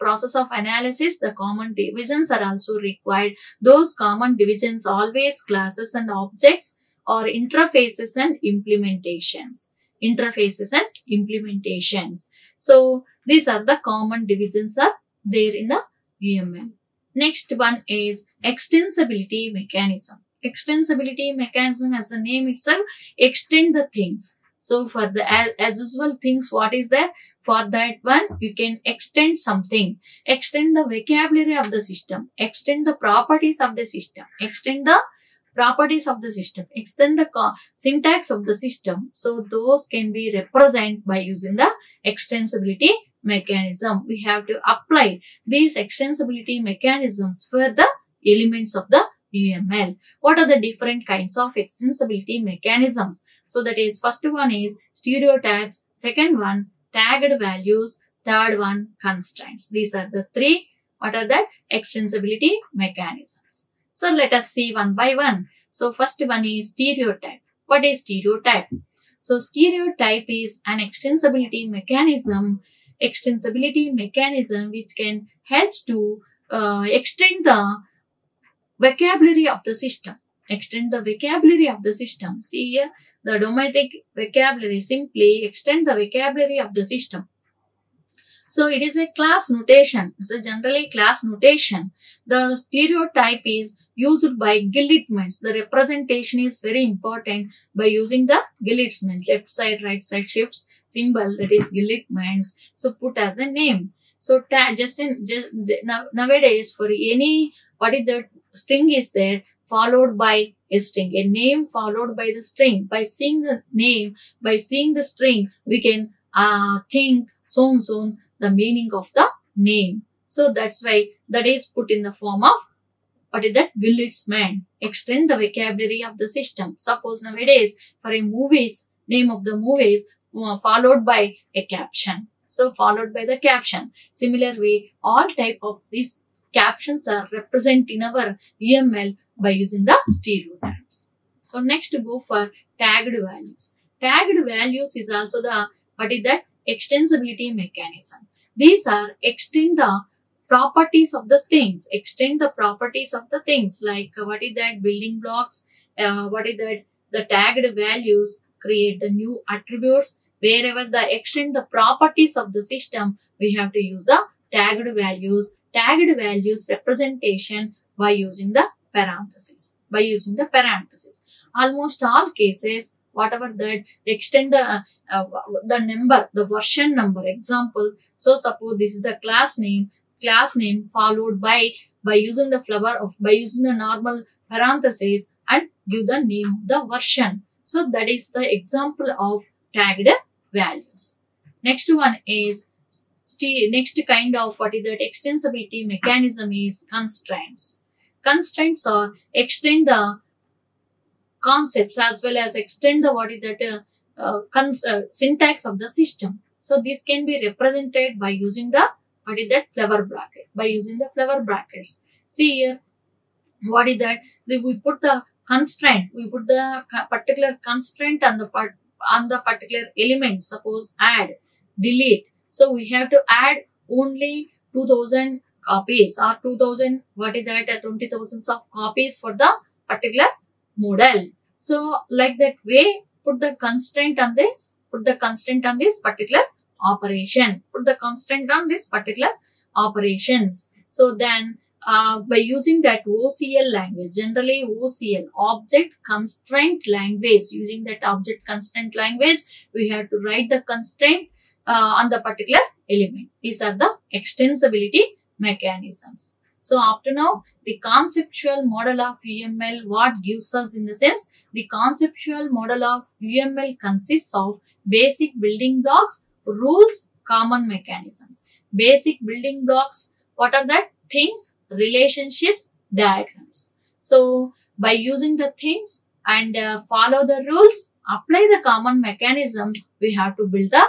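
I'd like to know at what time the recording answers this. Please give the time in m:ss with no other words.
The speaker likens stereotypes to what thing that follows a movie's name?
2:11.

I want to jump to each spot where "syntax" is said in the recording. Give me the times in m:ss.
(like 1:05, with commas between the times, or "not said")
0:37, 3:25.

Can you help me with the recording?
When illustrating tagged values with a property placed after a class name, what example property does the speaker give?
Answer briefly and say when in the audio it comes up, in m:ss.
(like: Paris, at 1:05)
Version number, at 2:56.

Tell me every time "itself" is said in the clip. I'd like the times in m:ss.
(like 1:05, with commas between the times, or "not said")
0:22.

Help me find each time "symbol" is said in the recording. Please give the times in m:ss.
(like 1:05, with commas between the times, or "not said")
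1:40.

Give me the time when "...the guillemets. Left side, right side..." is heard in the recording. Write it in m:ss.
1:38.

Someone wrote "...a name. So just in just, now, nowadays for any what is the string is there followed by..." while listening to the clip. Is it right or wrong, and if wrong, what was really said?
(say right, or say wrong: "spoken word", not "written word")
right.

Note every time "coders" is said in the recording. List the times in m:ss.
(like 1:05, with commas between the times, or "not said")
not said.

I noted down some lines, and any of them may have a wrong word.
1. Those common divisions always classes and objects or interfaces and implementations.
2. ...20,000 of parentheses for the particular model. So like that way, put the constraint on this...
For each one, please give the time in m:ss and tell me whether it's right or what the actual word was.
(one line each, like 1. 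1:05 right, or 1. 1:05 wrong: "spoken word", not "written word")
1. 0:03 right
2. 3:47 wrong: "copies", not "parentheses".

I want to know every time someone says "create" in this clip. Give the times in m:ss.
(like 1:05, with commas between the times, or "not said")
2:38.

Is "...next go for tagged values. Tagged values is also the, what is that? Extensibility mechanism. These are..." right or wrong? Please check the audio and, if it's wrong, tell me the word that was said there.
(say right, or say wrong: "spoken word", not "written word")
right.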